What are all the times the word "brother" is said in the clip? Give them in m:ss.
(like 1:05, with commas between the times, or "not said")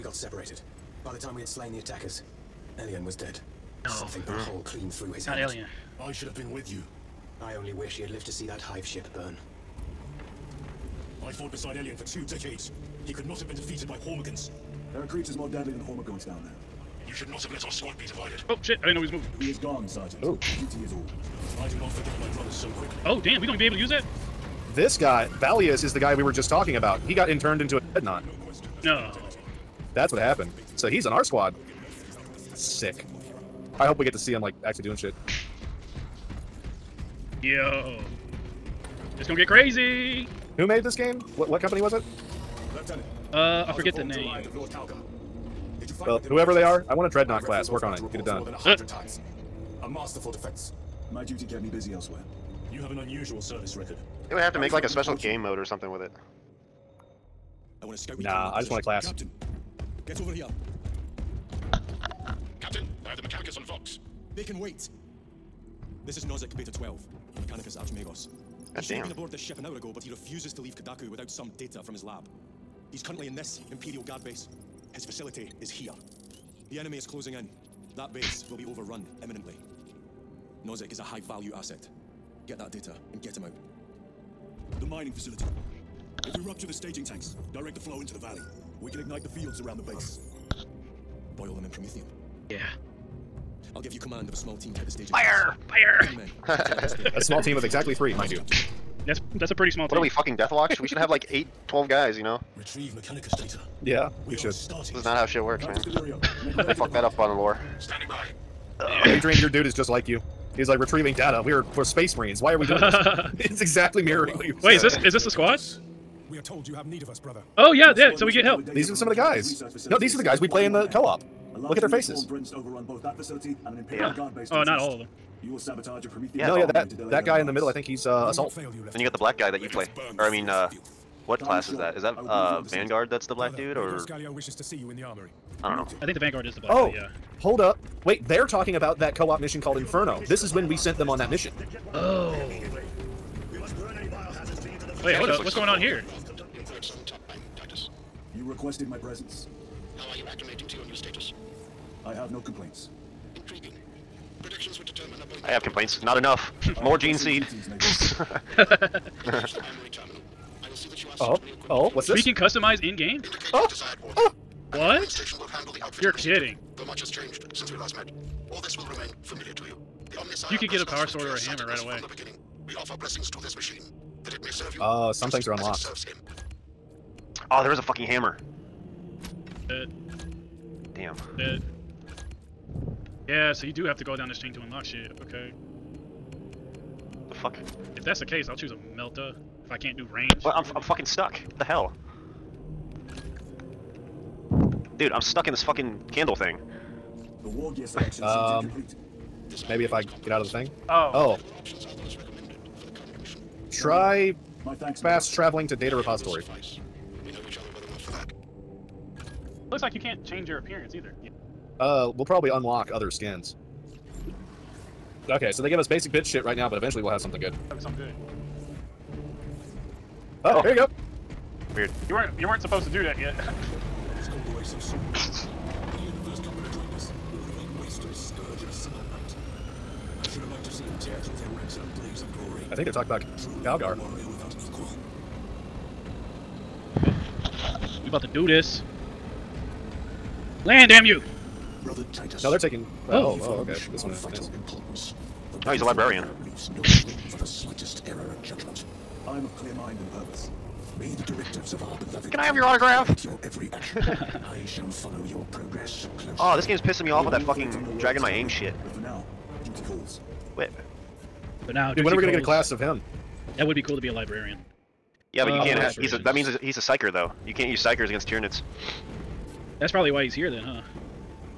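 1:57, 4:01.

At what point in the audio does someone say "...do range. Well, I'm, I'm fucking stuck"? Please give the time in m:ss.
3:09.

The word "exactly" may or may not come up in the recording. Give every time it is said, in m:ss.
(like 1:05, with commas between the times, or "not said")
1:37, 1:53.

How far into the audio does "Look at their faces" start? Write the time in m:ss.
2:01.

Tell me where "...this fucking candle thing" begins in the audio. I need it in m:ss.
3:15.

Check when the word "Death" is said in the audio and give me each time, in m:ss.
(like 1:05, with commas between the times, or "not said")
1:40.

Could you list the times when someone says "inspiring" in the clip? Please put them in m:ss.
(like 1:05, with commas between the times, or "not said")
not said.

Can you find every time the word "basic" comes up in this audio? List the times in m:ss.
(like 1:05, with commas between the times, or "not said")
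3:35.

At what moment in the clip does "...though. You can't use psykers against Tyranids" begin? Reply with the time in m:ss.
4:27.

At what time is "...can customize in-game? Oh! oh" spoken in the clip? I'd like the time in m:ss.
2:42.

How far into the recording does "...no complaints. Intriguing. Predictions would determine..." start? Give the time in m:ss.
2:32.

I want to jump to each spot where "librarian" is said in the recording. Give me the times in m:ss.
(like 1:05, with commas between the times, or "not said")
4:05, 4:24.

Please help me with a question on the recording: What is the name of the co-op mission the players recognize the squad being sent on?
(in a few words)
Inferno.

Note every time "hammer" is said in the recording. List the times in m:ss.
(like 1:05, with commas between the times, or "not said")
2:51, 2:58.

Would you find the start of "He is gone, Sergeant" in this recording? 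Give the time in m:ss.
0:19.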